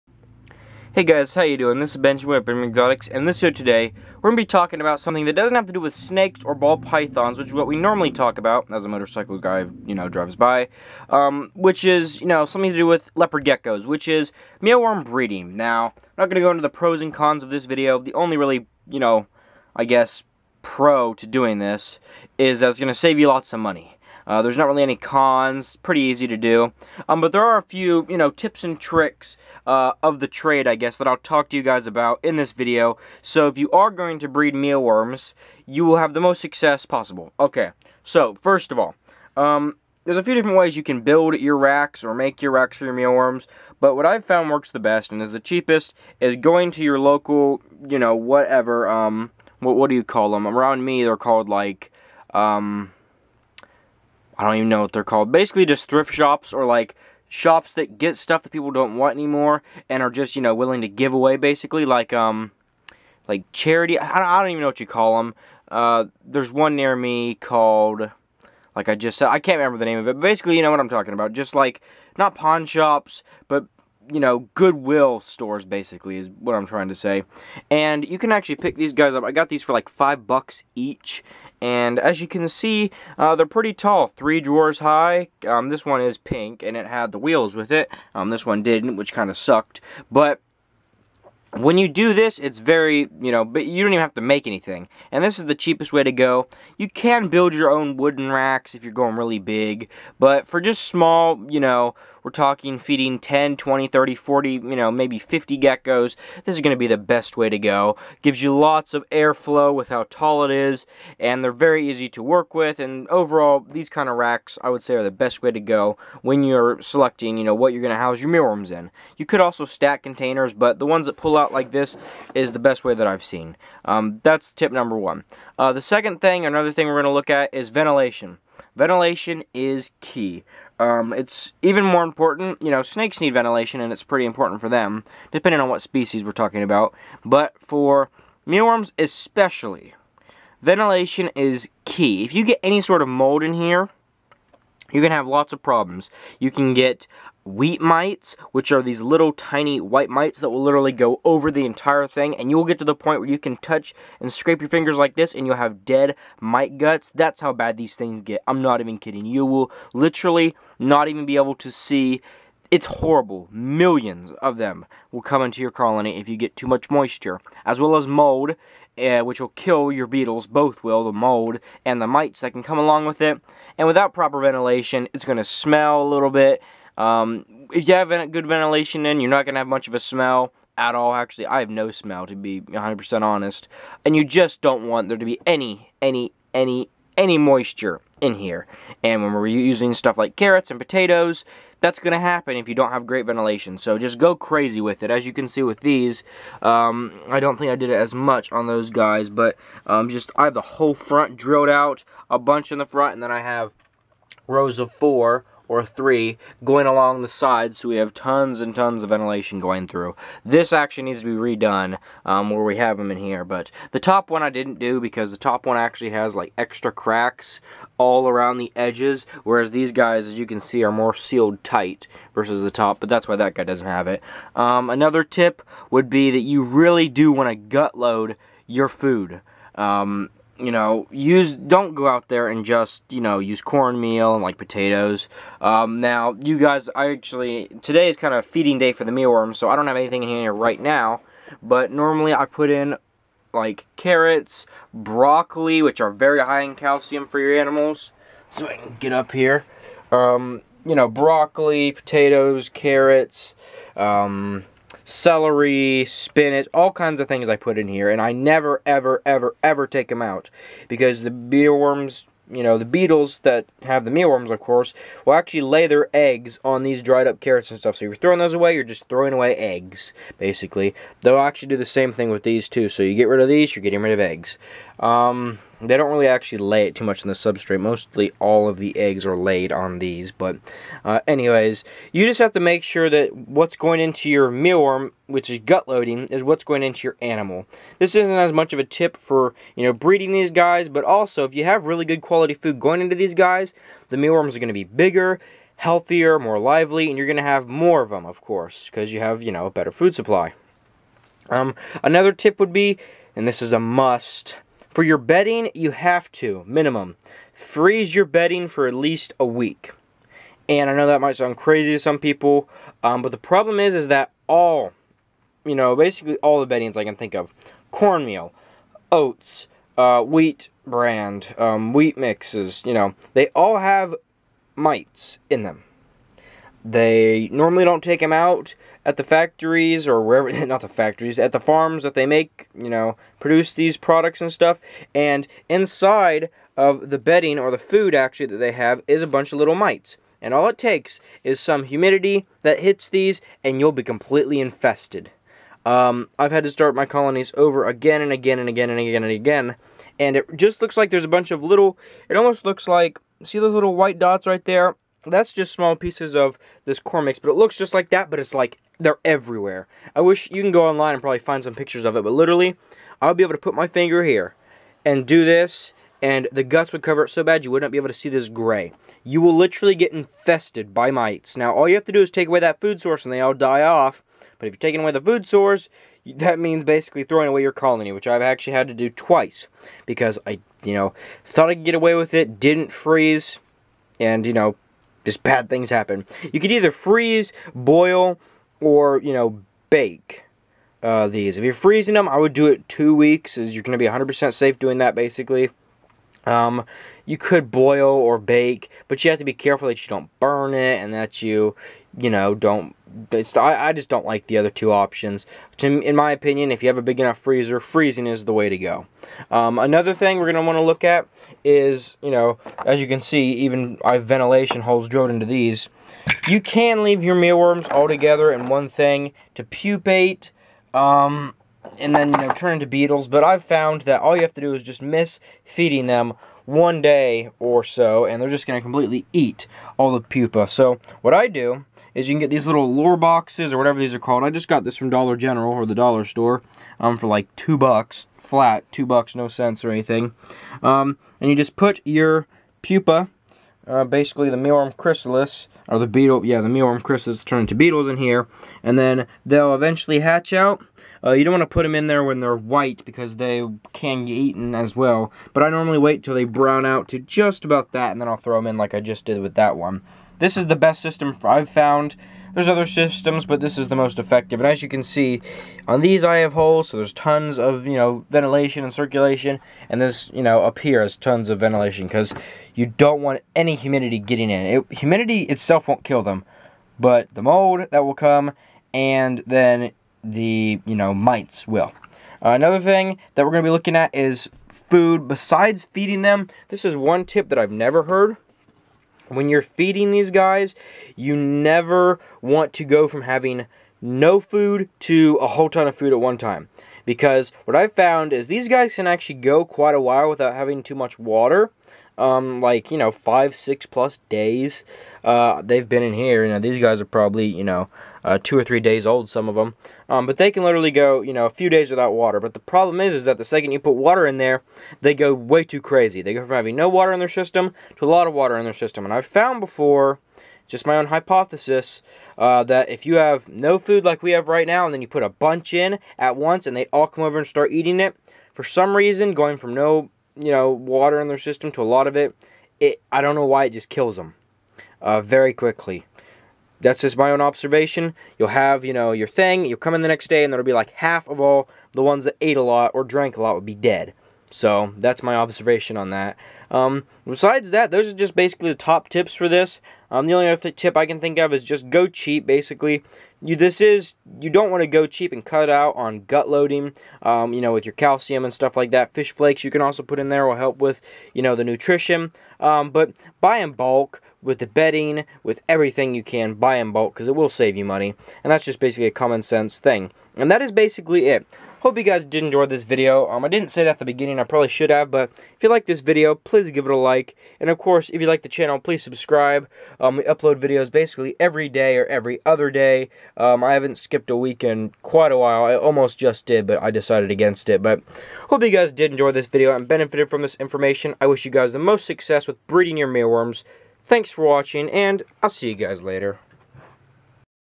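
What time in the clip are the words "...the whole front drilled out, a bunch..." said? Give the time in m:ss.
3:20.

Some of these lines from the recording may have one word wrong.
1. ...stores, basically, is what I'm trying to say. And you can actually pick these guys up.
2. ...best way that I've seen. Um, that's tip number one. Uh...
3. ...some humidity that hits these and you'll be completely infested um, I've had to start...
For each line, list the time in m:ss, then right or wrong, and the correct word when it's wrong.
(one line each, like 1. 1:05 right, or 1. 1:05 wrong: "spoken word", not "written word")
1. 1:15 right
2. 2:02 right
3. 5:41 right.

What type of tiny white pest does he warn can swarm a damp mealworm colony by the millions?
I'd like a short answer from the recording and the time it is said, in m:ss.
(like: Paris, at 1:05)
Wheat mites, at 2:27.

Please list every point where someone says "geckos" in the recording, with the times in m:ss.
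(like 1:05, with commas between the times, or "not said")
0:13, 1:45.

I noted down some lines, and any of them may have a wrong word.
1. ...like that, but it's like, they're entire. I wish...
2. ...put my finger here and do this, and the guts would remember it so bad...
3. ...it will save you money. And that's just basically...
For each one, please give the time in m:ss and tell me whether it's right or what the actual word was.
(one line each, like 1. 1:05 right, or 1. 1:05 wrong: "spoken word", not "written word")
1. 5:57 wrong: "everywhere", not "entire"
2. 6:03 wrong: "cover", not "remember"
3. 9:27 right.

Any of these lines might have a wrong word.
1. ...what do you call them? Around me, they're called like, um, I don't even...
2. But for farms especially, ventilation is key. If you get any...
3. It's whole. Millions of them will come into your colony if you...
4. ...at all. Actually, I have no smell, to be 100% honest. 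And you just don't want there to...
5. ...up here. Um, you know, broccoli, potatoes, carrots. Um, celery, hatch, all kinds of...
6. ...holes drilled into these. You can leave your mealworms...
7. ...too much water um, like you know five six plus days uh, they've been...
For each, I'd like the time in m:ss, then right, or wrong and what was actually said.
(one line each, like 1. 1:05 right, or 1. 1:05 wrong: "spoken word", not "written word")
1. 0:49 right
2. 2:17 wrong: "mealworms", not "farms"
3. 2:42 wrong: "horrible", not "whole"
4. 3:00 right
5. 4:09 wrong: "spinach", not "hatch"
6. 6:54 right
7. 8:20 right.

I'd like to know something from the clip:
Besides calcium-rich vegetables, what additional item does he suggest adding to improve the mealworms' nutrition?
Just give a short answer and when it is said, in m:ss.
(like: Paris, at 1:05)
Fish flakes, at 9:19.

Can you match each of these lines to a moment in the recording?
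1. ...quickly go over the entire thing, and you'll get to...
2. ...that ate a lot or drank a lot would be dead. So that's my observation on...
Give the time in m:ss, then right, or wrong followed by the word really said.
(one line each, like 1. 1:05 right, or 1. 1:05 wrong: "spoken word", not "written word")
1. 2:30 wrong: "literally", not "quickly"
2. 9:02 right.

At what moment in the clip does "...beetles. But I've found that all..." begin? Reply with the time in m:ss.
7:02.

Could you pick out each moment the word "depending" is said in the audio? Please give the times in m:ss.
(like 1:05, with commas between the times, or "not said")
2:15.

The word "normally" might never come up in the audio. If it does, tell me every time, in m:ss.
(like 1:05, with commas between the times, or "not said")
0:07, 4:01, 5:27, 7:35.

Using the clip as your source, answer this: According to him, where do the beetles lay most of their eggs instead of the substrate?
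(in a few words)
Dried up carrots.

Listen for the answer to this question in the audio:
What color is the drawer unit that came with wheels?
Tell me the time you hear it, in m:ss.
1:26.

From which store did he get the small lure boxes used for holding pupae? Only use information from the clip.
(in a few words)
Dollar General.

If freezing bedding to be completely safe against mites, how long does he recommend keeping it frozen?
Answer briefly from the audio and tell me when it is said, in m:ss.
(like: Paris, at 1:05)
2 weeks, at 6:32.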